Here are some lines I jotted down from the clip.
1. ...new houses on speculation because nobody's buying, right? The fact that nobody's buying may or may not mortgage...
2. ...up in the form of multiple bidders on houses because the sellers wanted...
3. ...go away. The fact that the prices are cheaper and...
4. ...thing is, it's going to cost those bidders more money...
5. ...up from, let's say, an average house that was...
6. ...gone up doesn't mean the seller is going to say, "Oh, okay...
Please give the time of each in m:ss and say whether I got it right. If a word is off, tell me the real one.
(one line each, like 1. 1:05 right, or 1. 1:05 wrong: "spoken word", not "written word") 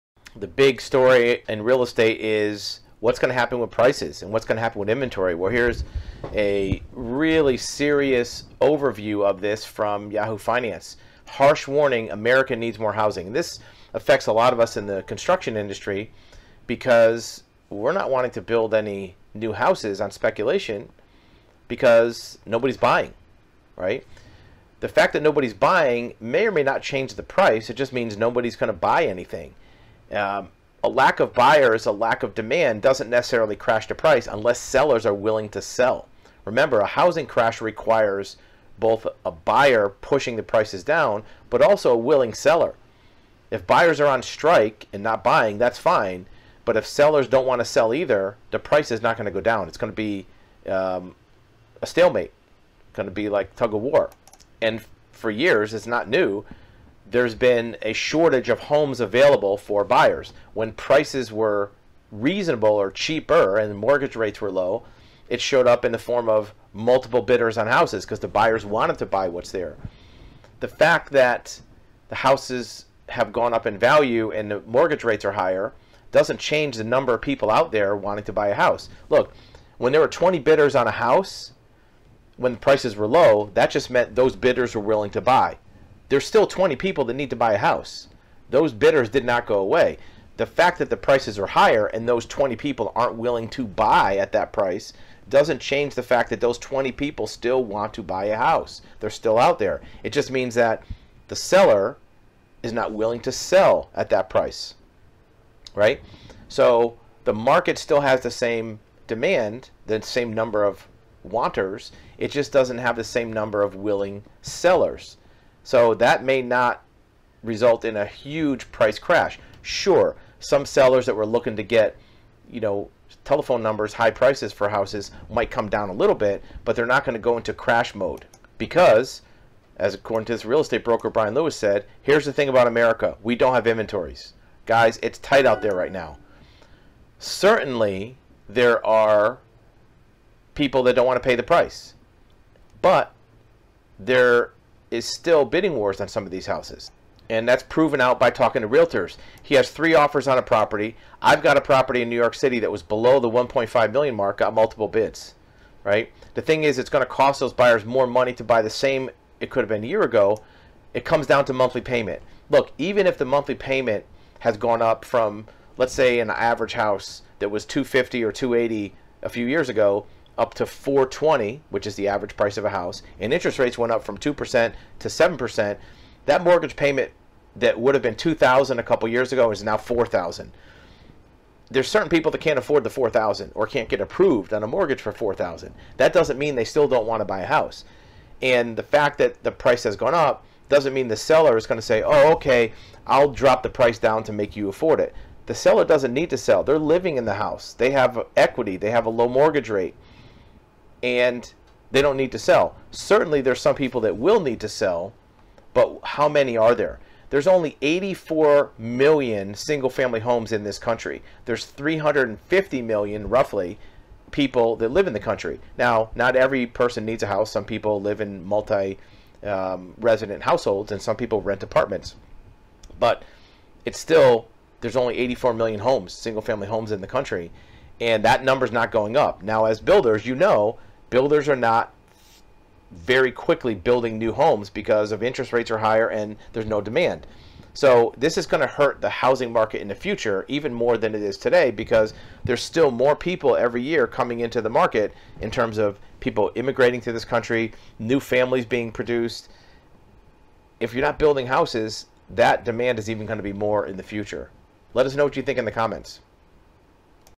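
1. 0:19 wrong: "change", not "mortgage"
2. 1:05 wrong: "buyers", not "sellers"
3. 1:29 wrong: "higher", not "cheaper"
4. 2:36 wrong: "buyers", not "bidders"
5. 2:44 right
6. 3:09 right.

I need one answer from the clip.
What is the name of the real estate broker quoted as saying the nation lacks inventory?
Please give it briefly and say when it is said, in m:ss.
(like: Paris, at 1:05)
Brian Lewis, at 2:11.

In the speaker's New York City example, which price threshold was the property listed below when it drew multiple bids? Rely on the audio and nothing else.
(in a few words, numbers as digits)
1.5 million.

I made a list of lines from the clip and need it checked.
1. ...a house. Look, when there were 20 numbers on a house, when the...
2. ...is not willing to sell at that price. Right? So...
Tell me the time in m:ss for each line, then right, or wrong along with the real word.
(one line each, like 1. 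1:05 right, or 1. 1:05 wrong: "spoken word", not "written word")
1. 1:18 wrong: "bidders", not "numbers"
2. 1:42 right.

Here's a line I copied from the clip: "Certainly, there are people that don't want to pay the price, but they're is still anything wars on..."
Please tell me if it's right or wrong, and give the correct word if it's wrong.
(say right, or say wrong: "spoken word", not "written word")
wrong: "bidding", not "anything".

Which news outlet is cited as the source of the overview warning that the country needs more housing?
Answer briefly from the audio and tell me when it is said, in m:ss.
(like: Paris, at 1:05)
Yahoo Finance, at 0:10.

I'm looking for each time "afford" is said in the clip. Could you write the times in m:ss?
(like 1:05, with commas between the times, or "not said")
3:02, 3:14.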